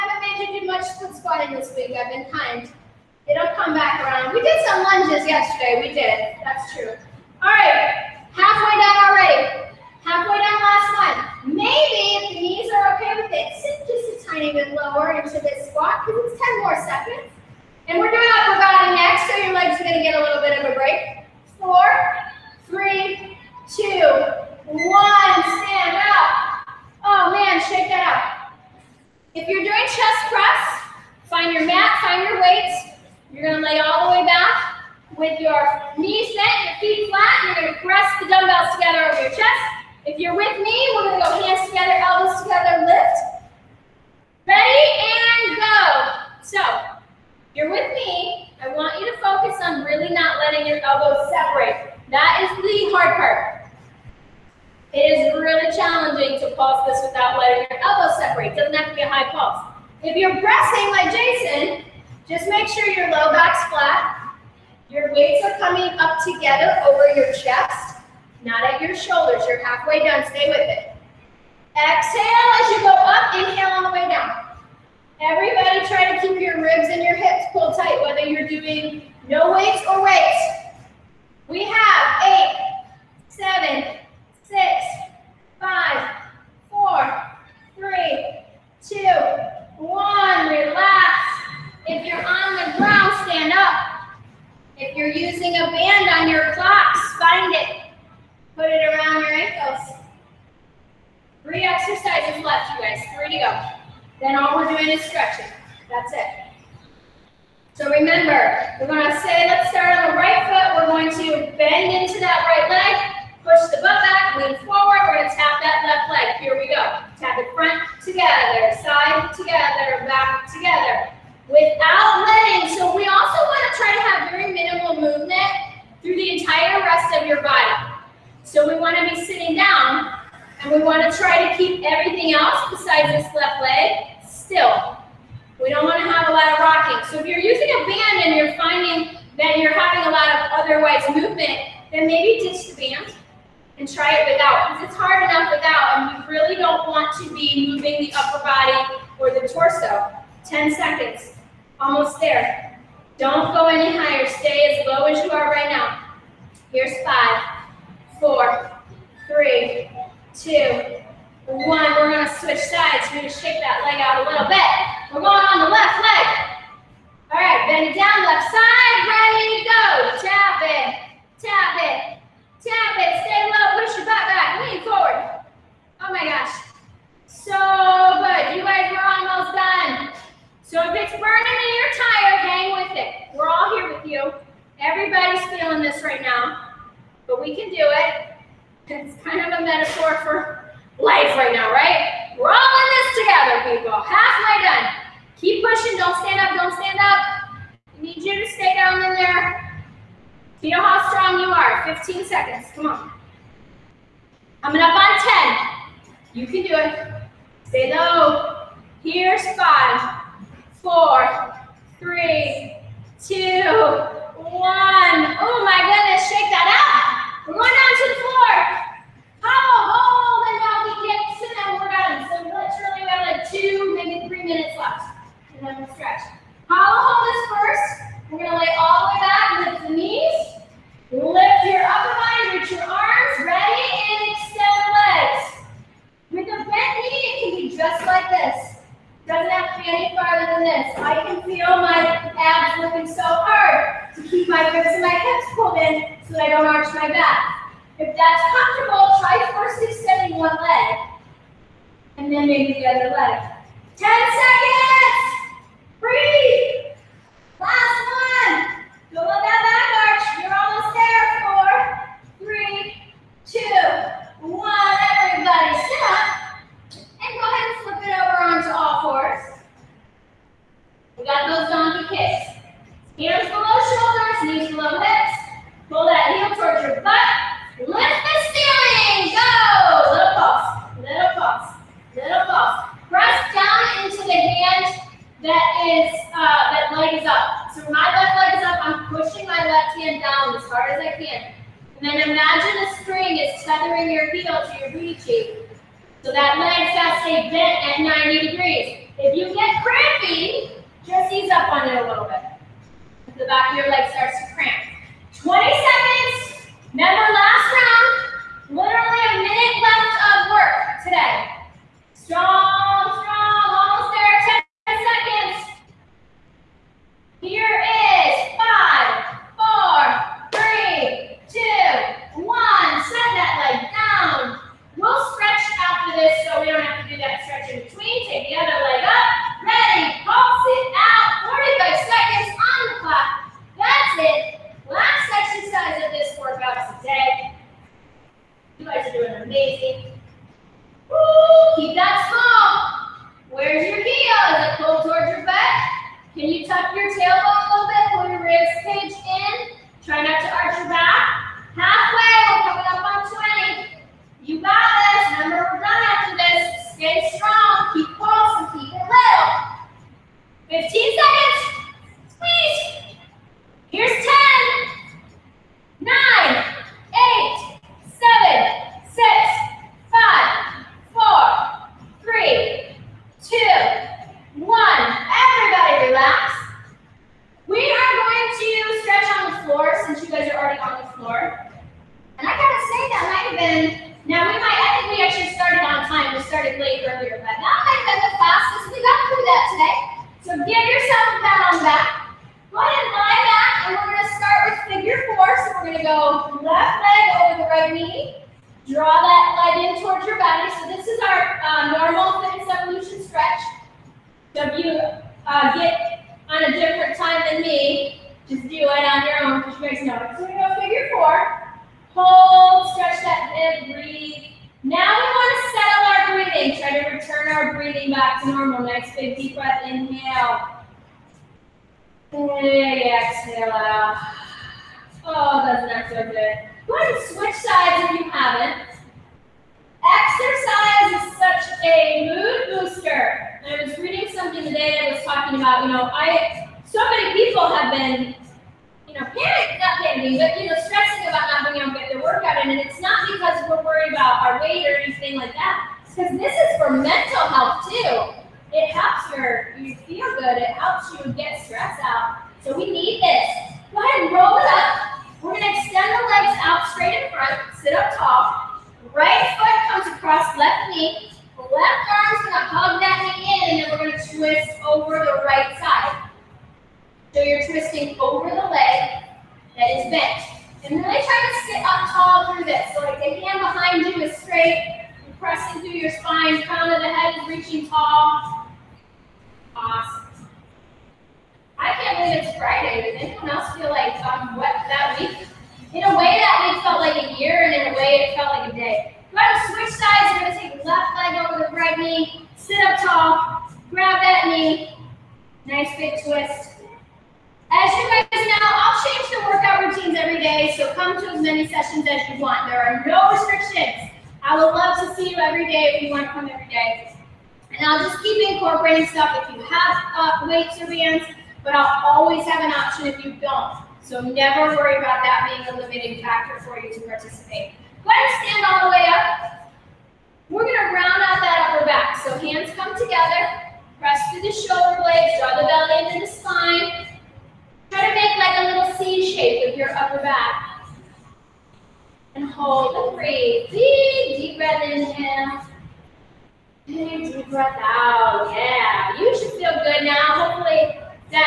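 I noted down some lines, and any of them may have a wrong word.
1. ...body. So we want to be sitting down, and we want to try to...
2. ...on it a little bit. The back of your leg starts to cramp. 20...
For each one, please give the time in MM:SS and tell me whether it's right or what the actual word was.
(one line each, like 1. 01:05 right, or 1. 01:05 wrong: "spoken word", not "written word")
1. 02:07 right
2. 05:01 right.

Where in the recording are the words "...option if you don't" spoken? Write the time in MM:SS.
08:32.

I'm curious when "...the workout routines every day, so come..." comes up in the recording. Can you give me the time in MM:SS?
08:19.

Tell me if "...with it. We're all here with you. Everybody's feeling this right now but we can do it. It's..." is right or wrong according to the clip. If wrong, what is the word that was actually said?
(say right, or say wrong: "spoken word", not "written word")
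right.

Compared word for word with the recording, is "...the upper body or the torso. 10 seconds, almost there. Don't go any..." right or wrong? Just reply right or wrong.
right.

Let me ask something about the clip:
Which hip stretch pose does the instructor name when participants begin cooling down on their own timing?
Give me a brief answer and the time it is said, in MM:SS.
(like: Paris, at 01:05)
Figure four, at 06:50.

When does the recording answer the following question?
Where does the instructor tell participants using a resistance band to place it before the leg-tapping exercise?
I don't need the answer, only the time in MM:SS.
01:38.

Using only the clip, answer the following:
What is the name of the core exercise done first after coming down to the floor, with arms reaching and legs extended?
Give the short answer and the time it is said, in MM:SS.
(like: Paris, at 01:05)
Hollow hold, at 03:46.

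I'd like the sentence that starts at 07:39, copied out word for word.
Right foot comes across left knee.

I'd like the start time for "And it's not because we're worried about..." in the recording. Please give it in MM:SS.
07:22.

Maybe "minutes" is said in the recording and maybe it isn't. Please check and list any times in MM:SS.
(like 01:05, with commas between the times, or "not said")
03:44, 05:09.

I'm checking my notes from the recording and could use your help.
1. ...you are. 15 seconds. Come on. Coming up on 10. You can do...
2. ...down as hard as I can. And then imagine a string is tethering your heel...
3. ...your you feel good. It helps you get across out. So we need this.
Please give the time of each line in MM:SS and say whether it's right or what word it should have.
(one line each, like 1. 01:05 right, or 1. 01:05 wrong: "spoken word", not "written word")
1. 03:21 right
2. 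04:50 right
3. 07:29 wrong: "stress", not "across".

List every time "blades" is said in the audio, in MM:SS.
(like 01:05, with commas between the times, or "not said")
08:45.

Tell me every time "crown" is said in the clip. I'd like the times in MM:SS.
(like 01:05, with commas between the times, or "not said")
07:56.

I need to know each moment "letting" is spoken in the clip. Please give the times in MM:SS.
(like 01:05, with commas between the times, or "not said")
02:02.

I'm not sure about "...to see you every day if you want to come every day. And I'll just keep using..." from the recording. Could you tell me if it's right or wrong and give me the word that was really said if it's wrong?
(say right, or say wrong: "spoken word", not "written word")
wrong: "incorporating", not "using".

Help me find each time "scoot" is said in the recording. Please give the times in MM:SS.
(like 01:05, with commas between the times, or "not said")
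not said.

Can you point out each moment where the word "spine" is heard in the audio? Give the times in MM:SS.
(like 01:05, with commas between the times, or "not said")
07:56, 08:46.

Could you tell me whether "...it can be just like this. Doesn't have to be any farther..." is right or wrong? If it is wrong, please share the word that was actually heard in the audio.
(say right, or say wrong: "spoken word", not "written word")
right.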